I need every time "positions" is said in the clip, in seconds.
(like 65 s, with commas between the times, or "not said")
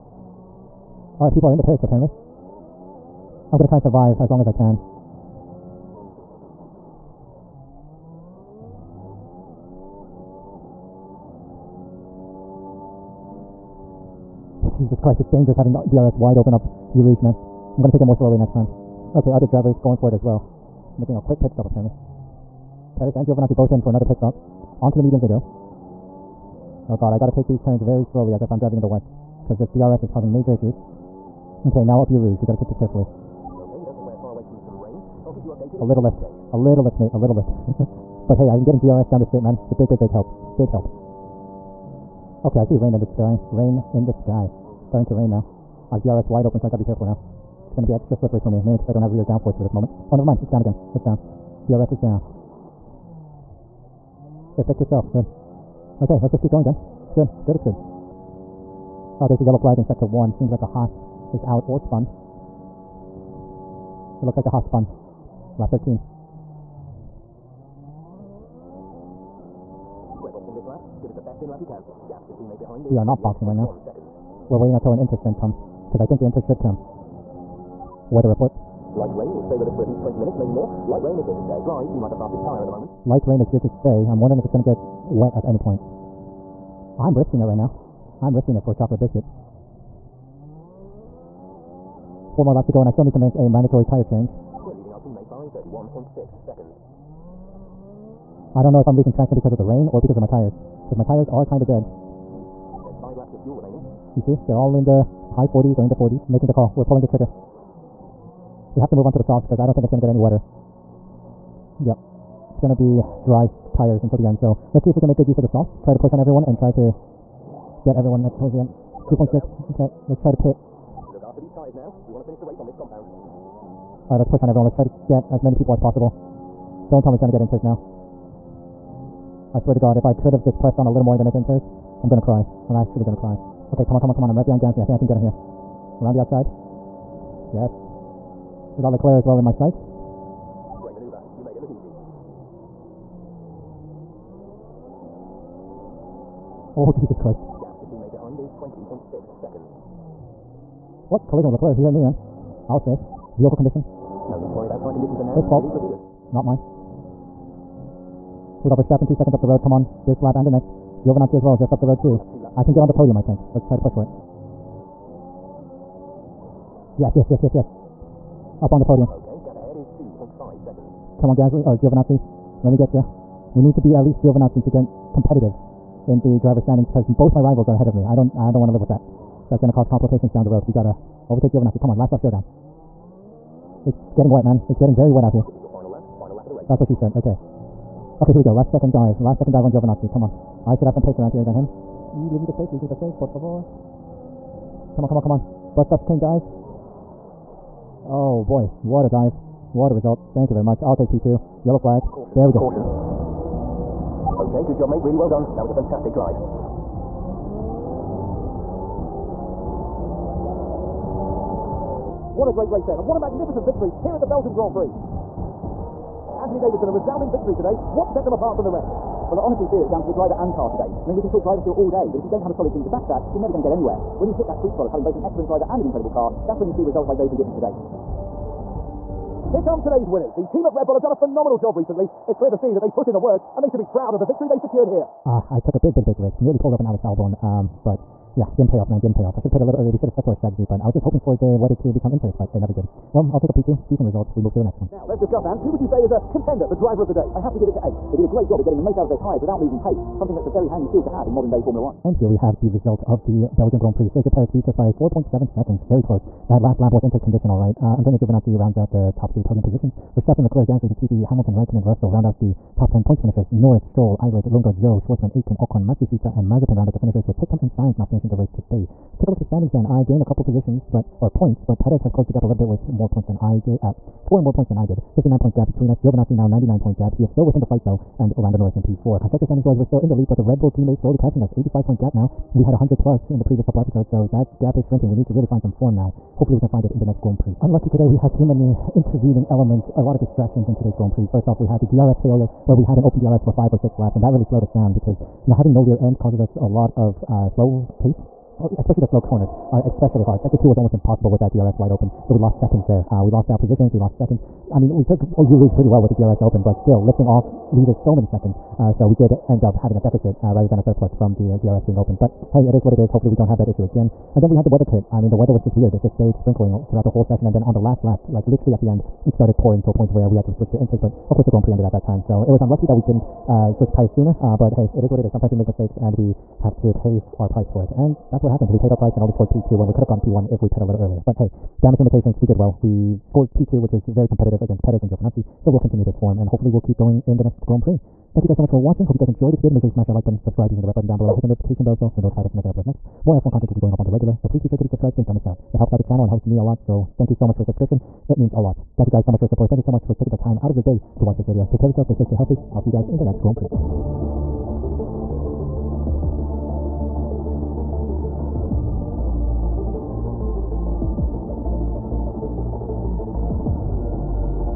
259 s, 270 s, 303 s.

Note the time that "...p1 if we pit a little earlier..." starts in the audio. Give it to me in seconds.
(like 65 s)
330 s.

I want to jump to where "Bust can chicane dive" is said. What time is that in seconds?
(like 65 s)
195 s.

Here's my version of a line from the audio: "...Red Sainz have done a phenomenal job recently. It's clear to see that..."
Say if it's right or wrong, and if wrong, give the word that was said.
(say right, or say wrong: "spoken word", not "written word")
wrong: "Bull", not "Sainz".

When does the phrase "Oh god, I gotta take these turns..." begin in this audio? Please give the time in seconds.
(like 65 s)
26 s.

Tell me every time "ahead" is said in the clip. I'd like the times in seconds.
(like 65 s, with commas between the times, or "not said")
169 s, 177 s.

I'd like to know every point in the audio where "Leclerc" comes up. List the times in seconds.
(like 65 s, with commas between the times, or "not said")
138 s, 151 s, 260 s.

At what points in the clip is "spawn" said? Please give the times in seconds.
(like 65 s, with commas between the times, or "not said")
not said.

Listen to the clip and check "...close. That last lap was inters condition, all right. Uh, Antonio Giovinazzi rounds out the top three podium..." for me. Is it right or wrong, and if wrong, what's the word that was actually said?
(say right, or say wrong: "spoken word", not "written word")
right.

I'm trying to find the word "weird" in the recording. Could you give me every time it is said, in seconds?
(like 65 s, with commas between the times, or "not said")
315 s.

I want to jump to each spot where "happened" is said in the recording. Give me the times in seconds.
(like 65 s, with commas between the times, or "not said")
328 s.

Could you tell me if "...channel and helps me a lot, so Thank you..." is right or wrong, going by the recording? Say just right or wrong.
right.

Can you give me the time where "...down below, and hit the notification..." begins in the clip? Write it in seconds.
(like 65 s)
341 s.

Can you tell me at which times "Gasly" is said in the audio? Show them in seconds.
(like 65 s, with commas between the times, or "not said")
134 s, 171 s, 260 s.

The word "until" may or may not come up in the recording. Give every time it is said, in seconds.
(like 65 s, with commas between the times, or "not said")
74 s, 114 s.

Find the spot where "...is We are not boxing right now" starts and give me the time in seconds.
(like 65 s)
72 s.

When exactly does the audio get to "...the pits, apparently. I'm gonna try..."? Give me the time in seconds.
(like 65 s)
1 s.